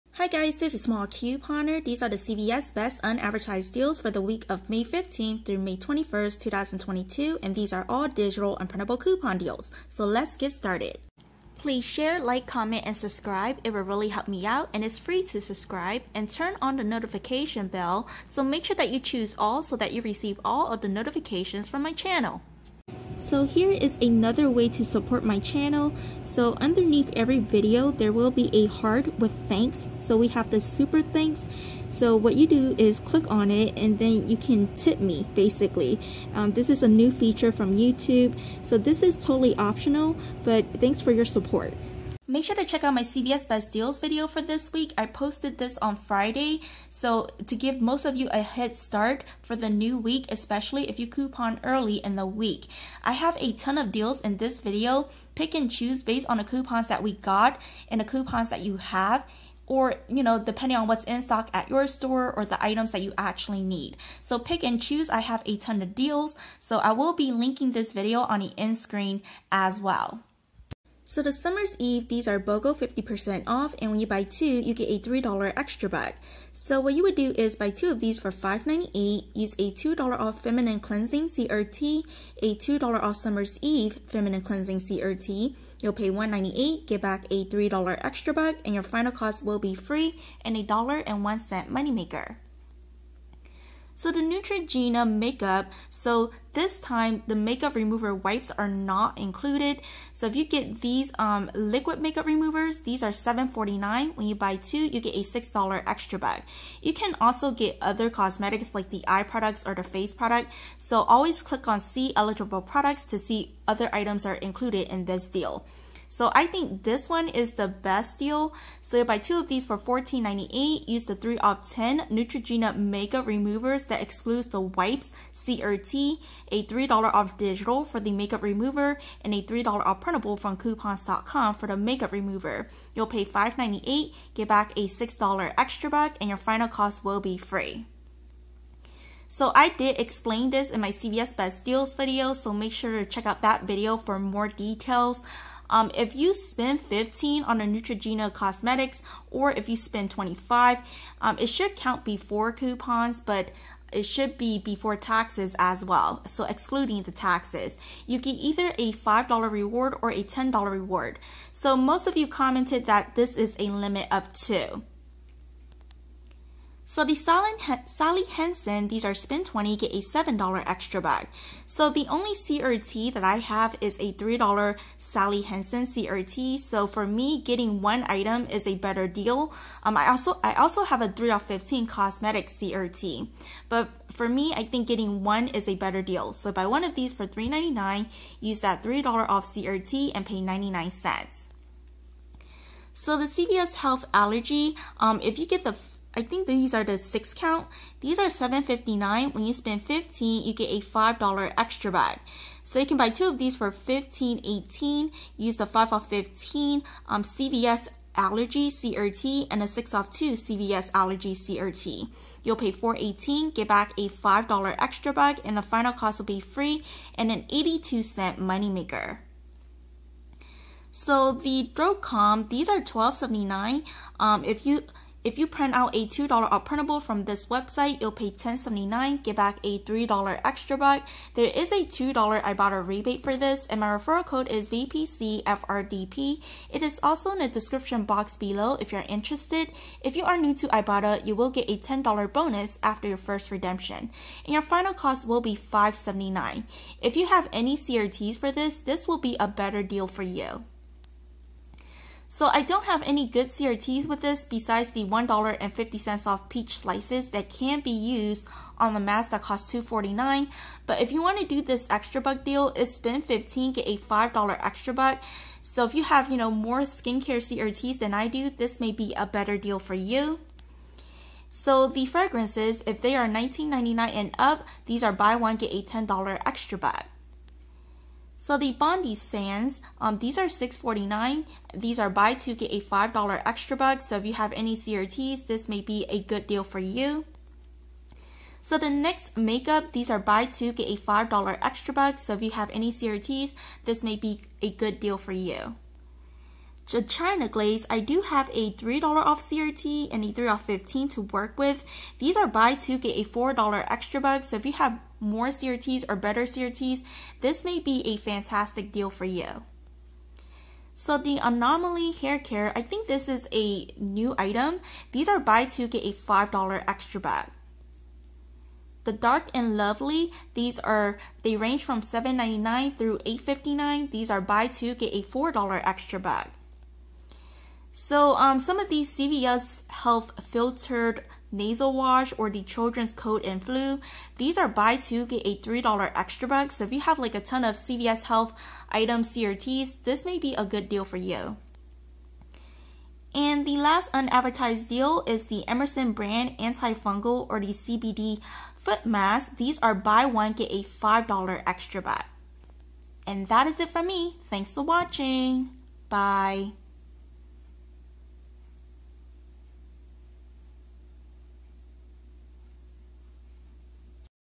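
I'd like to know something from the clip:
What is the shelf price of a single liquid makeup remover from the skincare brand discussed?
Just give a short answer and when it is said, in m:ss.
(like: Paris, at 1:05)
$7.49, at 1:43.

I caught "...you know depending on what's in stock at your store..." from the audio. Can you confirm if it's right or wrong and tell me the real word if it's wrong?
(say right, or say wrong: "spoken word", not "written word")
right.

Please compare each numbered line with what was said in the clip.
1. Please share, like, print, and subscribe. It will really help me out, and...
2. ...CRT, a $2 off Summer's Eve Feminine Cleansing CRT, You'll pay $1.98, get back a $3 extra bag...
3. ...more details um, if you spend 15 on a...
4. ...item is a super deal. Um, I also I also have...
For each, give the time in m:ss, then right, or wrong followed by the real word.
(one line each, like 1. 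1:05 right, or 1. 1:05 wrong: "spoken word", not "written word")
1. 0:11 wrong: "comment", not "print"
2. 1:21 right
3. 2:24 right
4. 2:58 wrong: "better", not "super".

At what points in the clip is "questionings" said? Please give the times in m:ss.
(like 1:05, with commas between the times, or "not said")
not said.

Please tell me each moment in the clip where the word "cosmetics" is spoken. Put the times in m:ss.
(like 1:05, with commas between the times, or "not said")
1:48, 2:28, 3:01.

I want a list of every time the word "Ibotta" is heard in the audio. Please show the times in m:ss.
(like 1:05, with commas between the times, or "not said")
3:52, 4:00.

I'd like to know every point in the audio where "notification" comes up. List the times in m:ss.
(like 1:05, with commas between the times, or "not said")
0:16, 0:20.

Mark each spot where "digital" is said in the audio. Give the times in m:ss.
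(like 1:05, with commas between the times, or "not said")
0:08, 2:07.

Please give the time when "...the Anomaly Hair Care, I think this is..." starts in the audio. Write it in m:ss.
5:11.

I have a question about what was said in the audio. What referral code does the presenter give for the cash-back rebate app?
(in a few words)
VPCFRDP.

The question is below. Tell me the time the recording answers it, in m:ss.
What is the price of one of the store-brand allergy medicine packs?
3:18.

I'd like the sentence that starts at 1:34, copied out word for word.
So the Neutrogena makeup, so this time the makeup remover wipes are not included.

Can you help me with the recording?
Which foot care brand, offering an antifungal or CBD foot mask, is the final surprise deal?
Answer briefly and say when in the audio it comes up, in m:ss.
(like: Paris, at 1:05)
Emerson, at 5:45.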